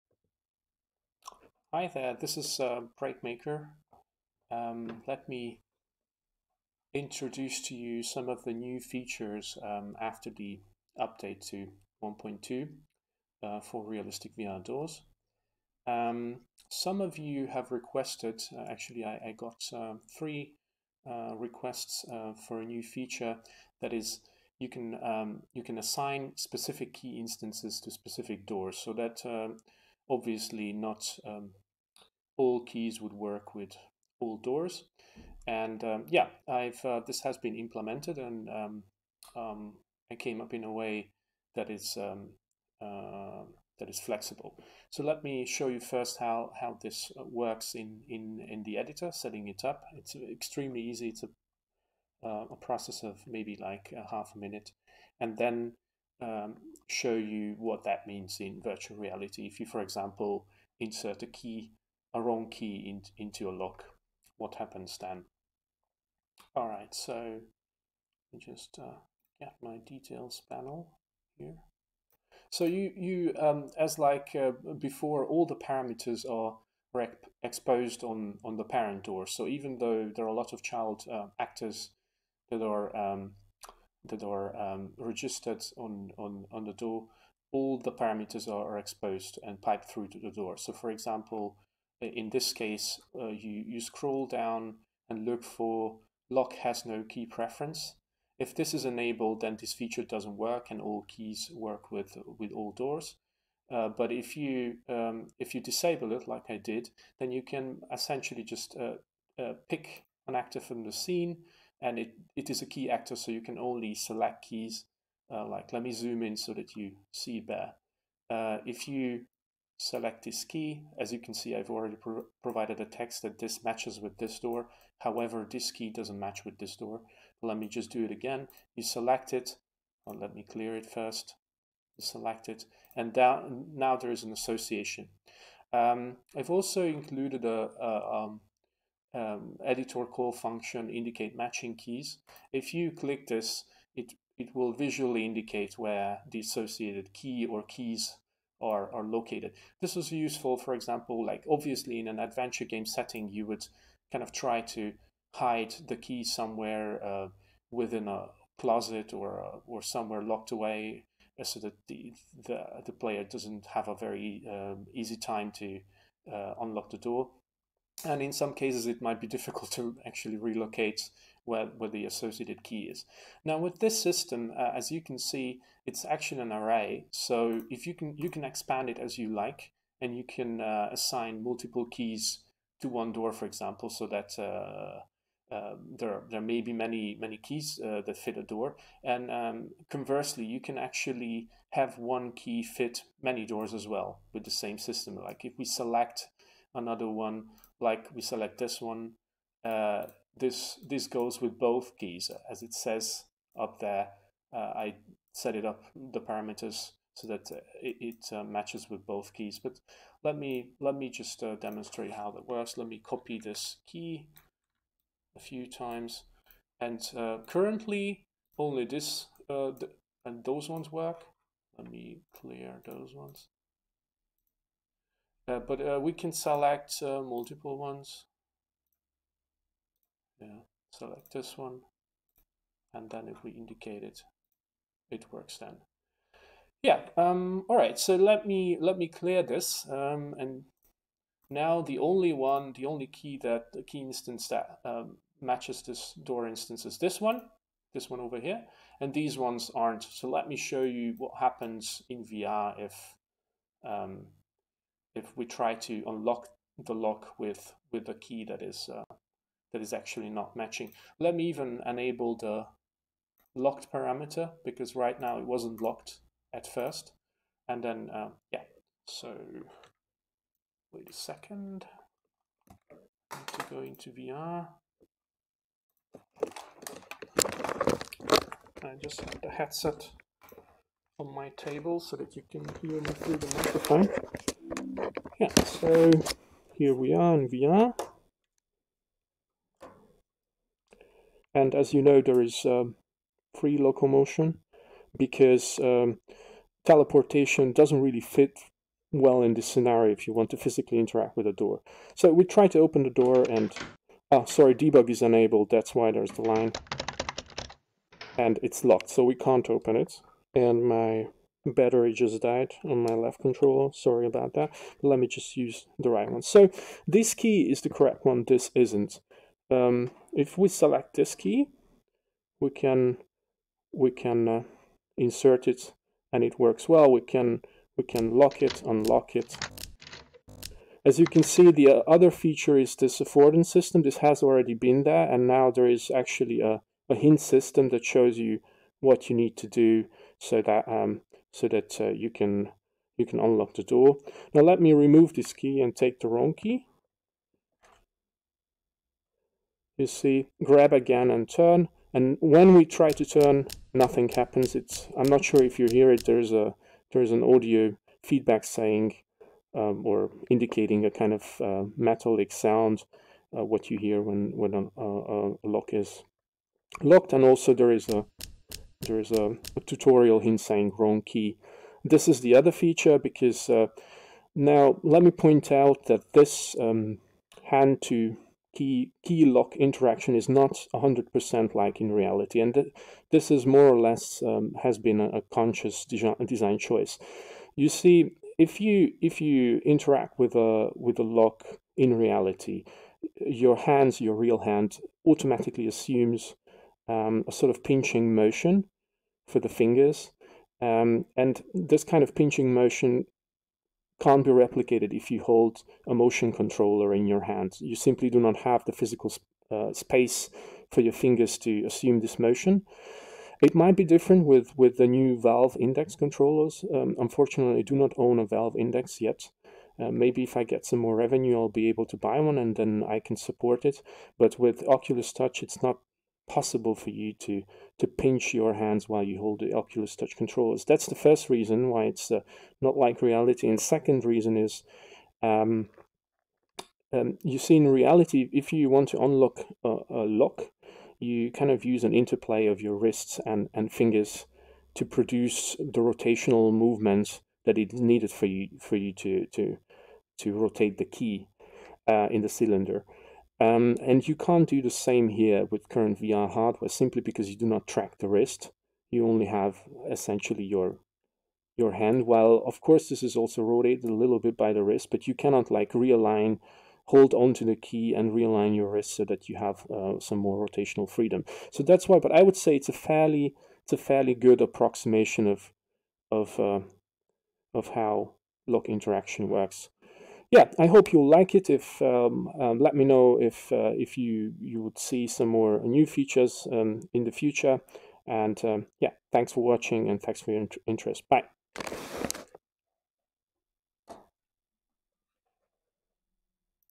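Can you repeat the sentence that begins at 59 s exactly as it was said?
If you, for example, insert a key a wrong key in, into your lock, what happens then?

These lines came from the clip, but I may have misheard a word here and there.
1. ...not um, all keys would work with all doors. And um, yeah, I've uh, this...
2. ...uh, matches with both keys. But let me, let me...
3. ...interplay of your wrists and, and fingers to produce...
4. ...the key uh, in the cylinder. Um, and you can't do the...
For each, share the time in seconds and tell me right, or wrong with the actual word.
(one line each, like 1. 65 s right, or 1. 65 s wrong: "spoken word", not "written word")
1. 30 s right
2. 208 s right
3. 442 s right
4. 450 s right.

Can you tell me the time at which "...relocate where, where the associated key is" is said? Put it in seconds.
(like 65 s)
170 s.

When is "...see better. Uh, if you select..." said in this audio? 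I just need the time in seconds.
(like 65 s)
117 s.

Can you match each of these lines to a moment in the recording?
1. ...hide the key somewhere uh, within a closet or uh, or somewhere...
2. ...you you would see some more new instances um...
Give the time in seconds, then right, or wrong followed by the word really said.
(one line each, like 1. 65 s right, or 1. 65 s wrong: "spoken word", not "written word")
1. 155 s right
2. 484 s wrong: "features", not "instances".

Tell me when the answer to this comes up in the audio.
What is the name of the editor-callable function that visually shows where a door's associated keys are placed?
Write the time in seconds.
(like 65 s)
140 s.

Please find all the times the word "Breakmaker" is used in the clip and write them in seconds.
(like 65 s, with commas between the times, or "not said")
3 s.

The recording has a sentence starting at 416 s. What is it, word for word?
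Um, unfortunately, I do not own a Valve Index yet.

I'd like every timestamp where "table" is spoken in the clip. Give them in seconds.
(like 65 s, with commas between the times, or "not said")
281 s.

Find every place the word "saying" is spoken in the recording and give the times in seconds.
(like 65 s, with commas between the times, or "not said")
358 s, 370 s.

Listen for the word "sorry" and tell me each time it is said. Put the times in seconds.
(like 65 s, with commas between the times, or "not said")
304 s, 313 s.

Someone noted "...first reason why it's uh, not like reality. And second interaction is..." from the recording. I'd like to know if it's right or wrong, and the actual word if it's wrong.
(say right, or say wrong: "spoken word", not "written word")
wrong: "reason", not "interaction".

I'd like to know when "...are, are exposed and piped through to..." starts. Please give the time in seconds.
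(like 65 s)
88 s.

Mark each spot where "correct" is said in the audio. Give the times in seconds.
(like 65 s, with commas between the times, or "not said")
317 s.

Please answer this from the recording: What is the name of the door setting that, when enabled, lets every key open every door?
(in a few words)
lock has no key preference.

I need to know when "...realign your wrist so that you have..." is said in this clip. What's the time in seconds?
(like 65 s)
468 s.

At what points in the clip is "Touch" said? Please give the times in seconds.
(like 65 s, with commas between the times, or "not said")
425 s, 430 s.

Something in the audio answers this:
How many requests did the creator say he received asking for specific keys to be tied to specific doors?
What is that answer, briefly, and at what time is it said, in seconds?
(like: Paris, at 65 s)
3, at 20 s.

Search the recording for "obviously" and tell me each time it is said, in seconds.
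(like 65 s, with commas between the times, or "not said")
30 s, 151 s.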